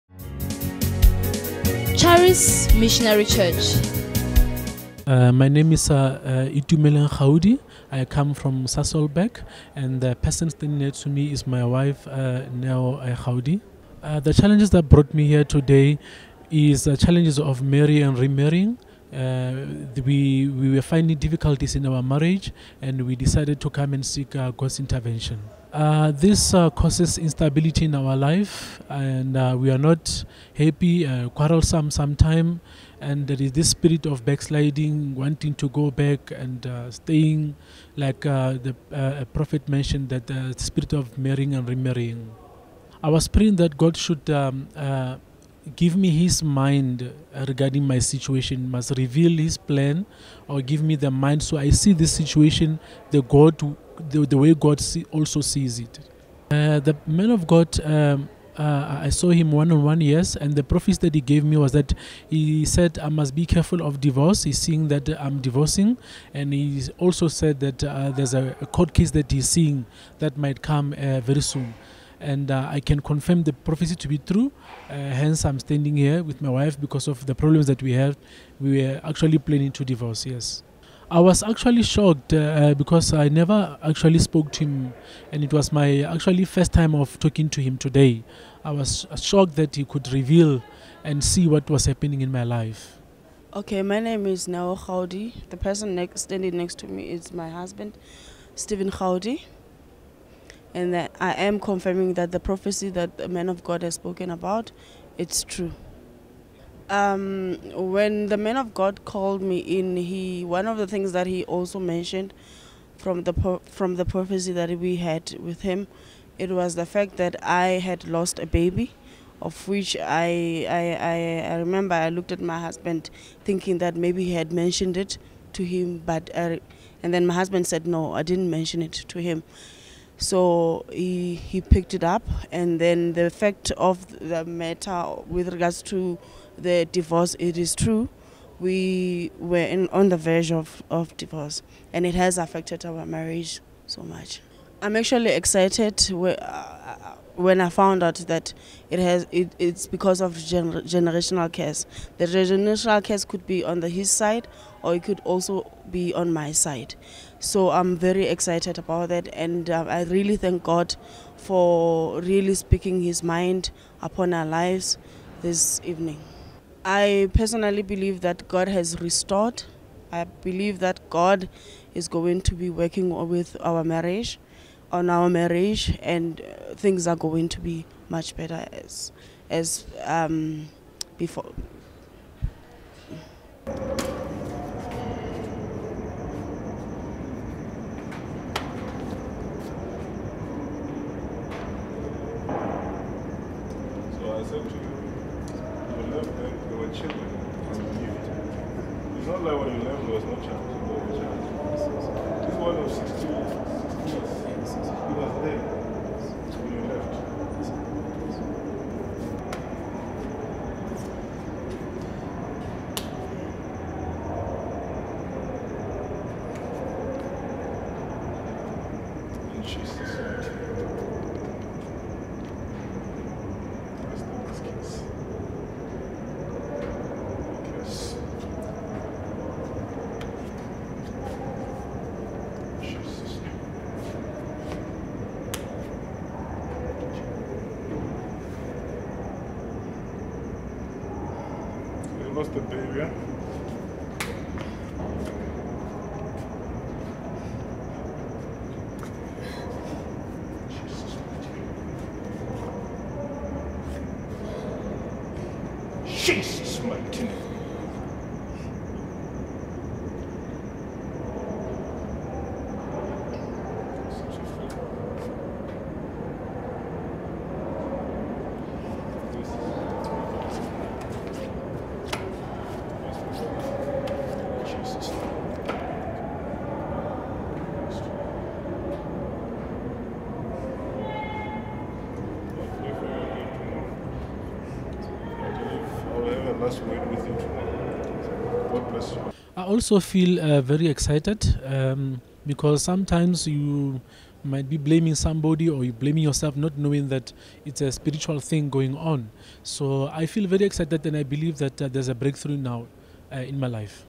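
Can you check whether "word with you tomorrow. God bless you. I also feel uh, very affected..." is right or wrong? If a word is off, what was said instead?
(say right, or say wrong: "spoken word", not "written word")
wrong: "excited", not "affected".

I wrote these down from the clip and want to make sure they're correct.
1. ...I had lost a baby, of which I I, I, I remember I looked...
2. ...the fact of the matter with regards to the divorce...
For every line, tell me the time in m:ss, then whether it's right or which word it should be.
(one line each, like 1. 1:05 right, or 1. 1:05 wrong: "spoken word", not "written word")
1. 1:57 right
2. 2:13 right.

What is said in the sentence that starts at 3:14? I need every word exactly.
It's not like when you left, there was no chance.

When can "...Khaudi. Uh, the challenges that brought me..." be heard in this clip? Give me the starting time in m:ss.
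0:13.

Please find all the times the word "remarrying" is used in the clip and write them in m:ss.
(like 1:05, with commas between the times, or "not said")
0:18, 0:41.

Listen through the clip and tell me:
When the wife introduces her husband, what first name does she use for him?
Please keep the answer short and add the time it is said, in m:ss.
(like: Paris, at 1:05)
Stephen, at 1:38.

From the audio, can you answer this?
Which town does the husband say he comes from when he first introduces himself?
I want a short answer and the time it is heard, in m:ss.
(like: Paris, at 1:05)
Sasolburg, at 0:08.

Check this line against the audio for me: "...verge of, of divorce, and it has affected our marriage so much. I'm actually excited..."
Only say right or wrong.
right.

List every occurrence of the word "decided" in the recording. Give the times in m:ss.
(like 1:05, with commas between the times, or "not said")
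0:23.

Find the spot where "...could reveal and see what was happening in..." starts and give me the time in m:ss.
1:29.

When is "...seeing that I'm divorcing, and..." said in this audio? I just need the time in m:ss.
1:04.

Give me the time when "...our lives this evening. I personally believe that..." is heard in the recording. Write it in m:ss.
2:44.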